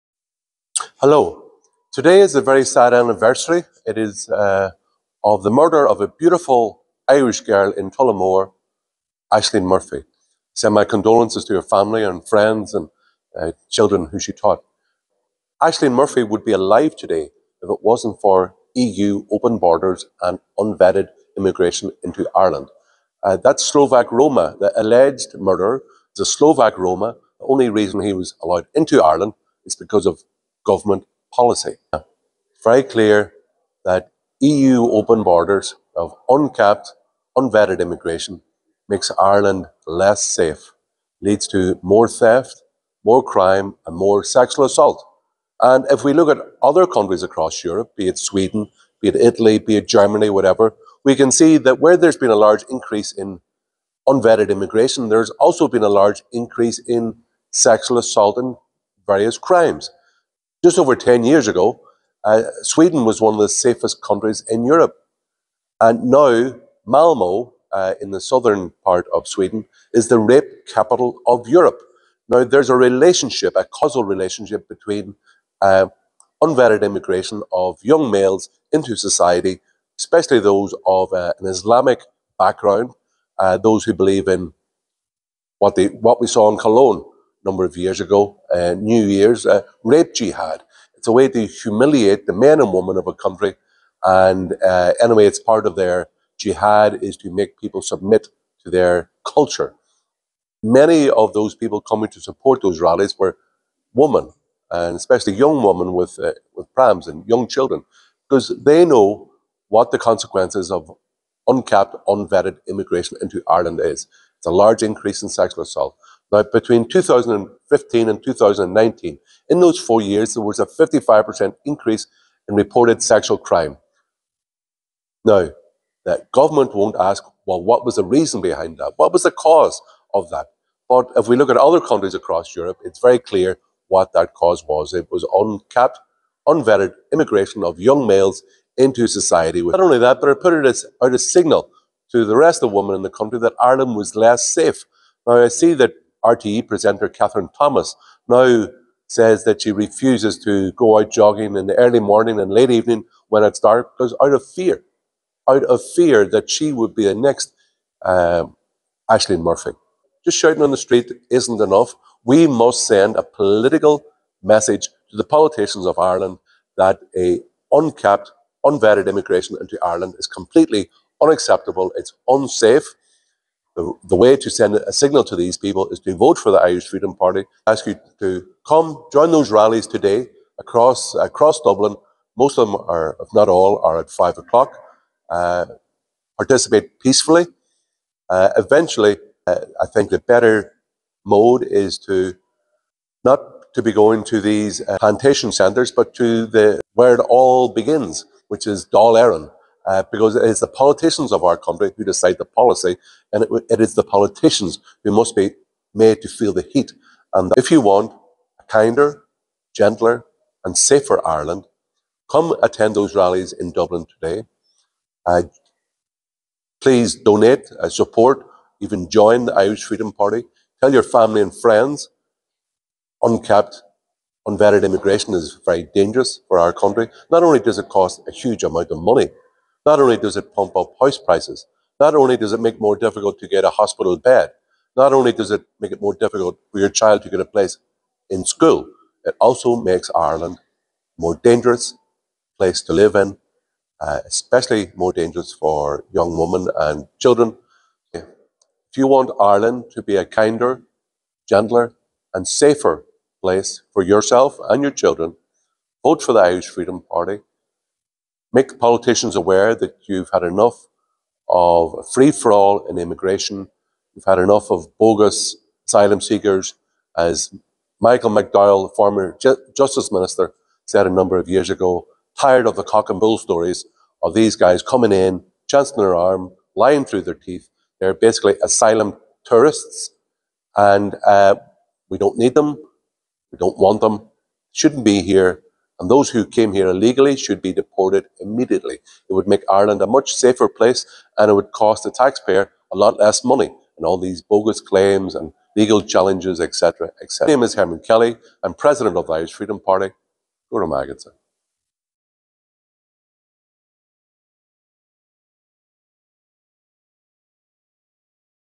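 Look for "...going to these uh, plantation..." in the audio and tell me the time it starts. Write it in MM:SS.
03:13.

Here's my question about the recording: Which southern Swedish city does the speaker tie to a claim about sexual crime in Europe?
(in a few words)
Malmo.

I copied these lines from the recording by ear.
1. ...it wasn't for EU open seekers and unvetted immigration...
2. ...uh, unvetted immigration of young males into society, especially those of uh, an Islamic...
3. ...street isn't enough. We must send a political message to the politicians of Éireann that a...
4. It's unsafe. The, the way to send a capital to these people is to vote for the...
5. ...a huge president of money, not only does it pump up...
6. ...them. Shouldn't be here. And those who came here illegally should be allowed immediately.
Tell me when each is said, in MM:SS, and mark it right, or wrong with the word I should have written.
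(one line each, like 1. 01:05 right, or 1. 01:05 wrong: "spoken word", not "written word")
1. 00:17 wrong: "borders", not "seekers"
2. 01:15 right
3. 02:40 wrong: "Ireland", not "Éireann"
4. 02:51 wrong: "signal", not "capital"
5. 03:48 wrong: "amount", not "president"
6. 04:44 wrong: "deported", not "allowed".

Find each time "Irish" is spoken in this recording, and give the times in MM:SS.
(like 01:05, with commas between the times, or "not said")
00:07, 02:56, 03:39, 04:16, 04:59.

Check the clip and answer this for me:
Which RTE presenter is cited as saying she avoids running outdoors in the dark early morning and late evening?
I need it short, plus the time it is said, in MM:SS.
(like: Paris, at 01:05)
Kathryn Thomas, at 02:27.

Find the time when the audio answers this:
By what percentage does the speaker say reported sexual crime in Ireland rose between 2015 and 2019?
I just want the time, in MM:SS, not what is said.
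02:00.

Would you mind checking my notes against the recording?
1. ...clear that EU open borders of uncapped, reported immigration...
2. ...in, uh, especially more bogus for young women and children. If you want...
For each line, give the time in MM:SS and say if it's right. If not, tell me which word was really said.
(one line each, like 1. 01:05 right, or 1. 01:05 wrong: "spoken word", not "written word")
1. 00:32 wrong: "unvetted", not "reported"
2. 04:03 wrong: "dangerous", not "bogus".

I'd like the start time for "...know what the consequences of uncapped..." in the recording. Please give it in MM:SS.
01:48.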